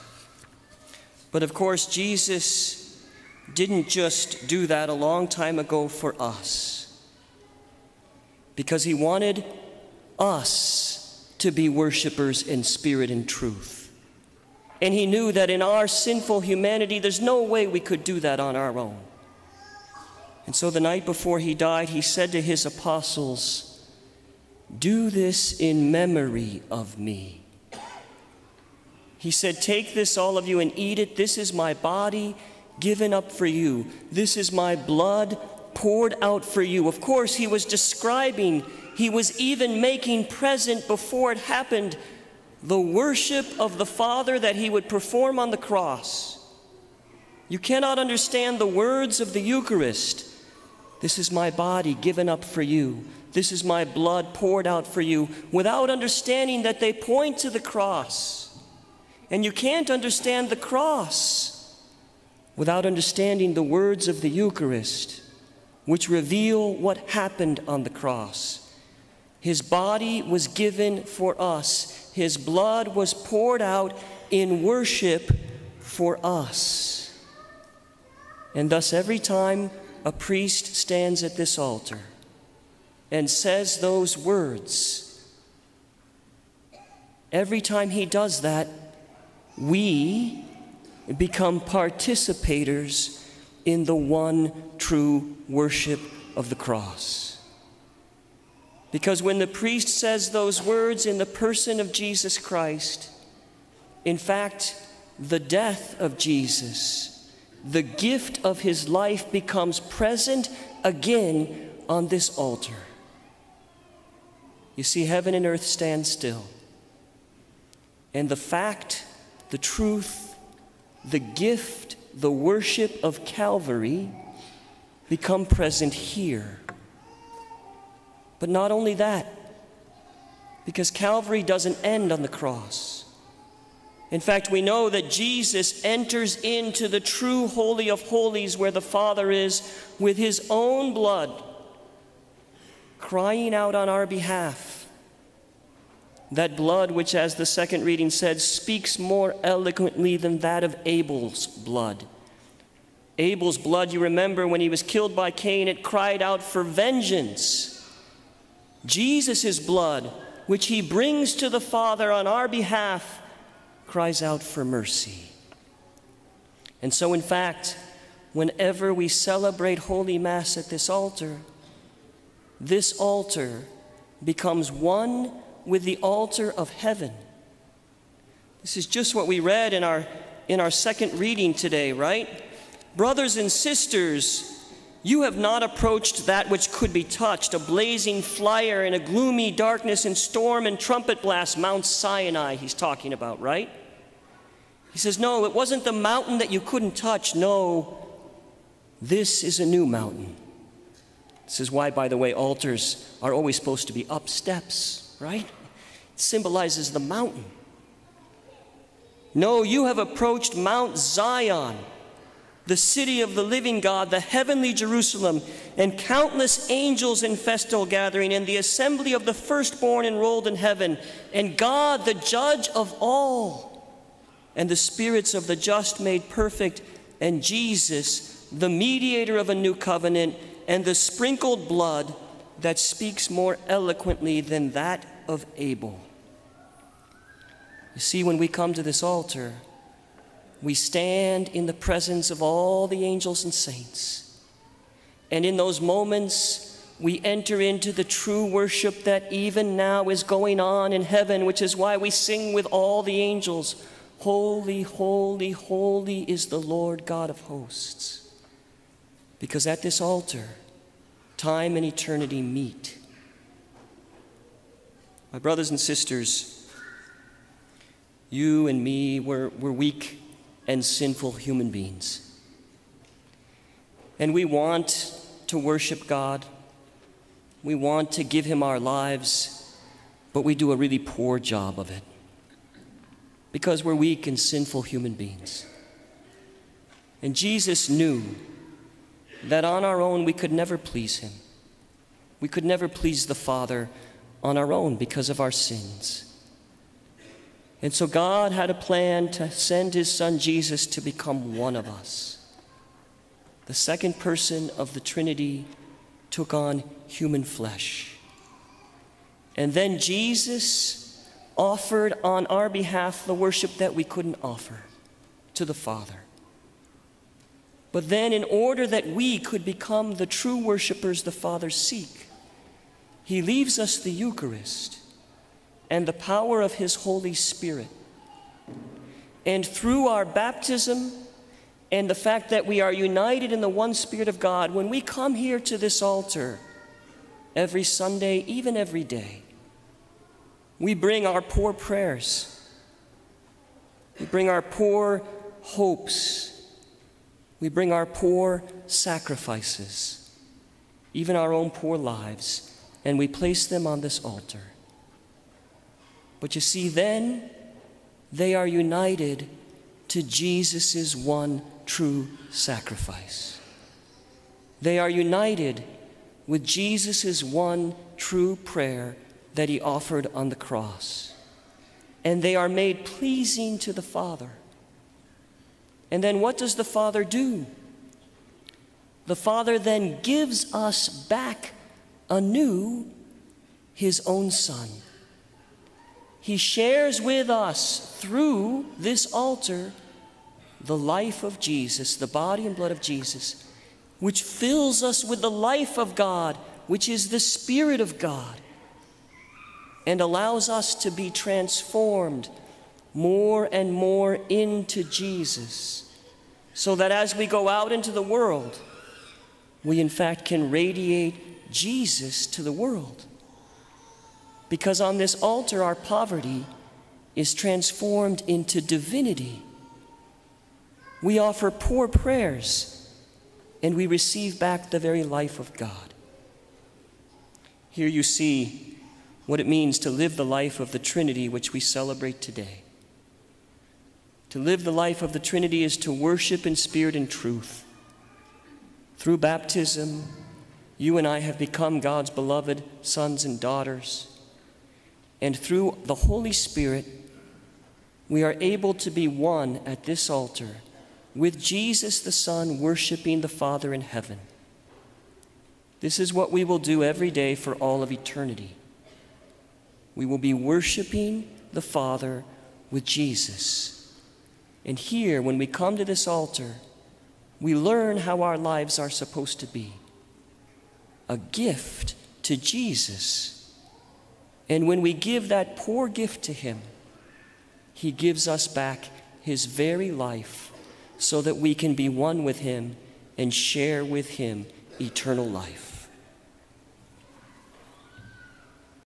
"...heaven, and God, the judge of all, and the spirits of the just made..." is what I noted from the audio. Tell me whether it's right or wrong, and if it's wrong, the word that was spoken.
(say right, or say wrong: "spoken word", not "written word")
right.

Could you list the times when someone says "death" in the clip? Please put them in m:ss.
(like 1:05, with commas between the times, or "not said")
1:45.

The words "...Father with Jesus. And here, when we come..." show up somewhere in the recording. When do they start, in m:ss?
7:41.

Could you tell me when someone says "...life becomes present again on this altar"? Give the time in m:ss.
1:48.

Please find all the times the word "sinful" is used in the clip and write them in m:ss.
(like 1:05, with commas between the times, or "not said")
0:15, 4:30, 4:44.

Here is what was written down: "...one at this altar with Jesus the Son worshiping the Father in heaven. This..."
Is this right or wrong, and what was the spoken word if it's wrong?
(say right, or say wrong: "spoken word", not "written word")
right.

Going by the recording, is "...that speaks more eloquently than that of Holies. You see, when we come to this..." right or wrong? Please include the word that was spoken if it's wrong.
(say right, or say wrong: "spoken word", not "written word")
wrong: "Abel", not "Holies".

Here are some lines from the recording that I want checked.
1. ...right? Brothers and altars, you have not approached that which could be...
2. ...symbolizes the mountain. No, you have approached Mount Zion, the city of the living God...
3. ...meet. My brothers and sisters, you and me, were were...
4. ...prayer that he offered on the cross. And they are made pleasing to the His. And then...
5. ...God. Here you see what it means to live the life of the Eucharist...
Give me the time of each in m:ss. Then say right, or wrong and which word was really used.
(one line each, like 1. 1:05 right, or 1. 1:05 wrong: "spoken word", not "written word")
1. 3:01 wrong: "sisters", not "altars"
2. 3:26 right
3. 4:22 right
4. 6:08 wrong: "Father", not "His"
5. 7:05 wrong: "Trinity", not "Eucharist".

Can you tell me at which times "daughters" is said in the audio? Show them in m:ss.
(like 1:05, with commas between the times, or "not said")
7:23.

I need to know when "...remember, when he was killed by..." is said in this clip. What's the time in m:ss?
2:33.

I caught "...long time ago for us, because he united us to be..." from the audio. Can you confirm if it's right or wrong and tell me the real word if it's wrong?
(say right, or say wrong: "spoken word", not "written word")
wrong: "wanted", not "united".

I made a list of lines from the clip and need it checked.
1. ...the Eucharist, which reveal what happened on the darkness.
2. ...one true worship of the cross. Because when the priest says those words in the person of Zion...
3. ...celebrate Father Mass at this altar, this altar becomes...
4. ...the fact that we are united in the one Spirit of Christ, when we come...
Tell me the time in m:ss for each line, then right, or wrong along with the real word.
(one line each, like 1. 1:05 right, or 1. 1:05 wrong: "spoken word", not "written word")
1. 1:04 wrong: "cross", not "darkness"
2. 1:33 wrong: "Jesus", not "Zion"
3. 2:49 wrong: "Holy", not "Father"
4. 5:32 wrong: "God", not "Christ".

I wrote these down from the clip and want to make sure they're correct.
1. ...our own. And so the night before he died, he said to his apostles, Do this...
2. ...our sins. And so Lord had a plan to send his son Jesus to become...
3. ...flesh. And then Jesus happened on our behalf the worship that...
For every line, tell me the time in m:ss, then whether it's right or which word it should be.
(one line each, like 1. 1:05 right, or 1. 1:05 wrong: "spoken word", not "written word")
1. 0:18 right
2. 4:55 wrong: "God", not "Lord"
3. 5:07 wrong: "offered", not "happened".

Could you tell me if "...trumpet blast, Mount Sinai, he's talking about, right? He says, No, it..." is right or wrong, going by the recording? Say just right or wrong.
right.